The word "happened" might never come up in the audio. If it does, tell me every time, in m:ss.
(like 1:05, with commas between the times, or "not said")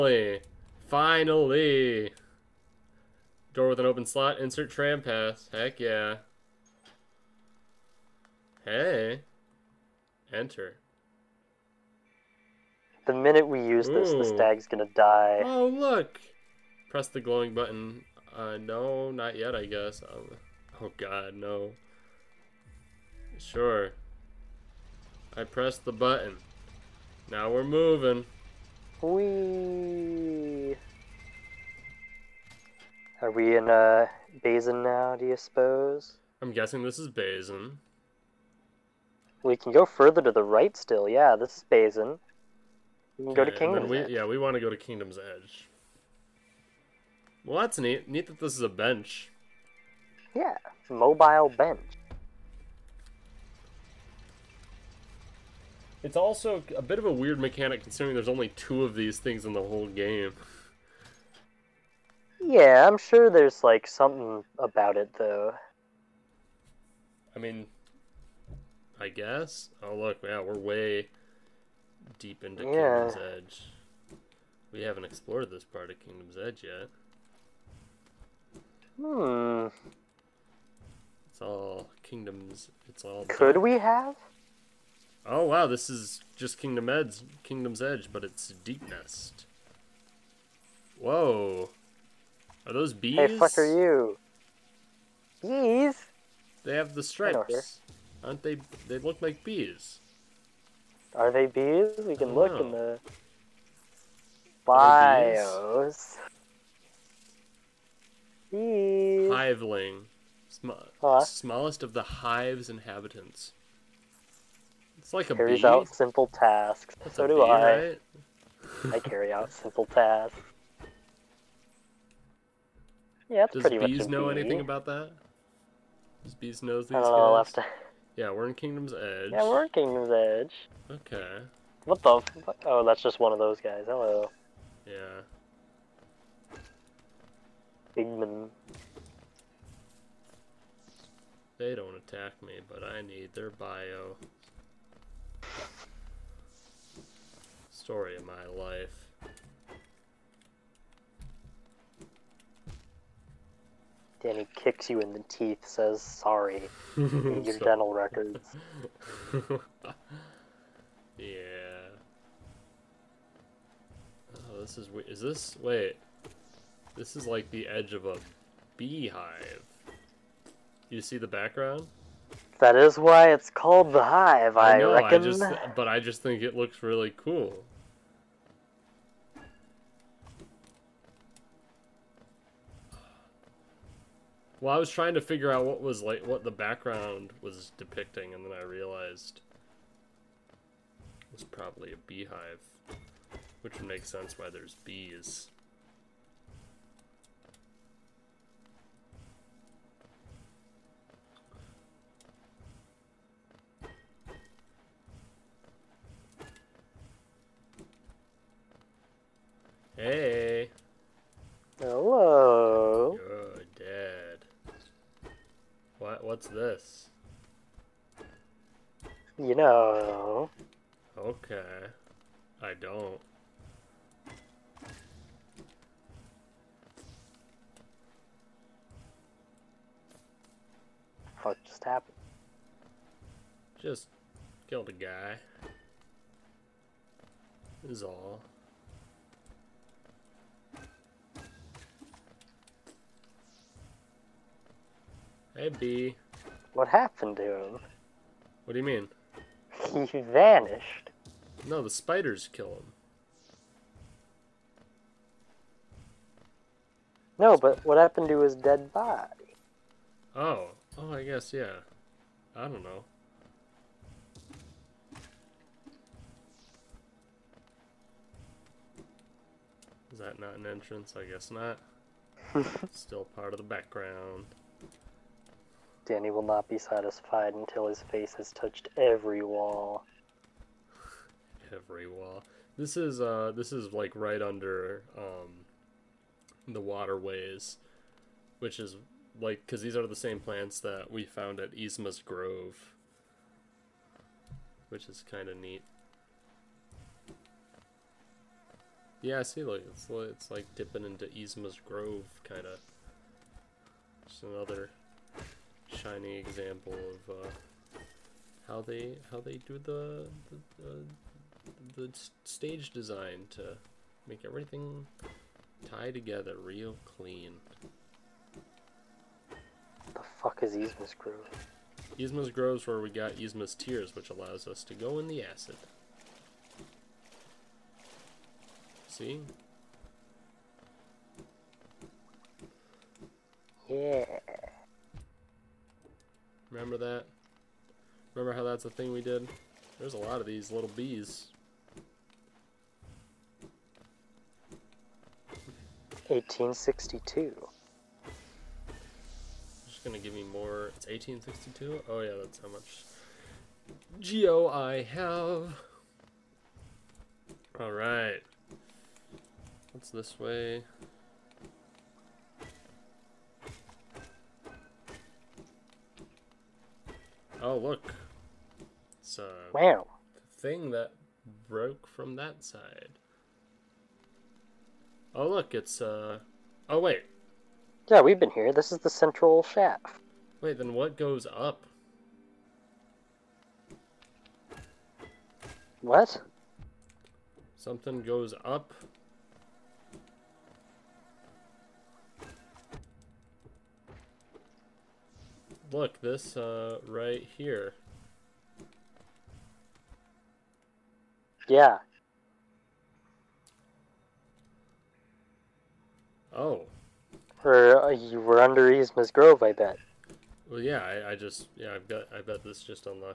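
3:51, 4:06, 4:17.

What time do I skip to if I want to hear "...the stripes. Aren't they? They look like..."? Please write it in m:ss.
1:36.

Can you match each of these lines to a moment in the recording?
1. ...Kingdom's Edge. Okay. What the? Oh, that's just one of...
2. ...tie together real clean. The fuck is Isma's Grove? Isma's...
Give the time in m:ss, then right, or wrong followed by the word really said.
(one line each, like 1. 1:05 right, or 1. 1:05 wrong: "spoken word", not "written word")
1. 2:09 right
2. 5:15 right.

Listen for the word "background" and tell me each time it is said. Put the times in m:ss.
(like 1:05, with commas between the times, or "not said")
2:51, 3:06, 4:33.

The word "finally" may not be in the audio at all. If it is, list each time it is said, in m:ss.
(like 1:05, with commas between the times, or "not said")
0:00.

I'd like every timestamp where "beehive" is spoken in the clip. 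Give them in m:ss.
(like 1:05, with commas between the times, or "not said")
2:48, 3:12.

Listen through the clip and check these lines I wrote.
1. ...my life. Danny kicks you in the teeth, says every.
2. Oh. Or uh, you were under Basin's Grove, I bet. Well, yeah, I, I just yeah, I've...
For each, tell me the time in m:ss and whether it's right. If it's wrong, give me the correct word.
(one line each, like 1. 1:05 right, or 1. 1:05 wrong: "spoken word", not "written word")
1. 2:28 wrong: "sorry", not "every"
2. 6:46 wrong: "Isma", not "Basin".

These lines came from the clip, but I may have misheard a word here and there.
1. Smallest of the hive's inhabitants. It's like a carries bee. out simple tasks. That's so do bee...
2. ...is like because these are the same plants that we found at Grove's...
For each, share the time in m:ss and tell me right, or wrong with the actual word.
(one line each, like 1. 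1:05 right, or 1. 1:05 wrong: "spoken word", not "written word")
1. 1:51 right
2. 4:48 wrong: "Isma", not "Grove".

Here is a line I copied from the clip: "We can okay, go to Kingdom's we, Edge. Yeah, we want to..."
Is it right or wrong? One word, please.
right.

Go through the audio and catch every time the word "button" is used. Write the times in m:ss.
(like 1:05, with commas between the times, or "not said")
0:17, 0:25.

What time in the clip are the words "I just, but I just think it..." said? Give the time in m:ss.
2:55.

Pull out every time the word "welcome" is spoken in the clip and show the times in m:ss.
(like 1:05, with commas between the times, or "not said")
not said.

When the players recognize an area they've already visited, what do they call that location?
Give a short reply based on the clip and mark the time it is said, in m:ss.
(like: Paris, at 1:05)
The central shaft, at 6:19.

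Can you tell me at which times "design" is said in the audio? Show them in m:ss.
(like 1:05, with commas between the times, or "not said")
5:12.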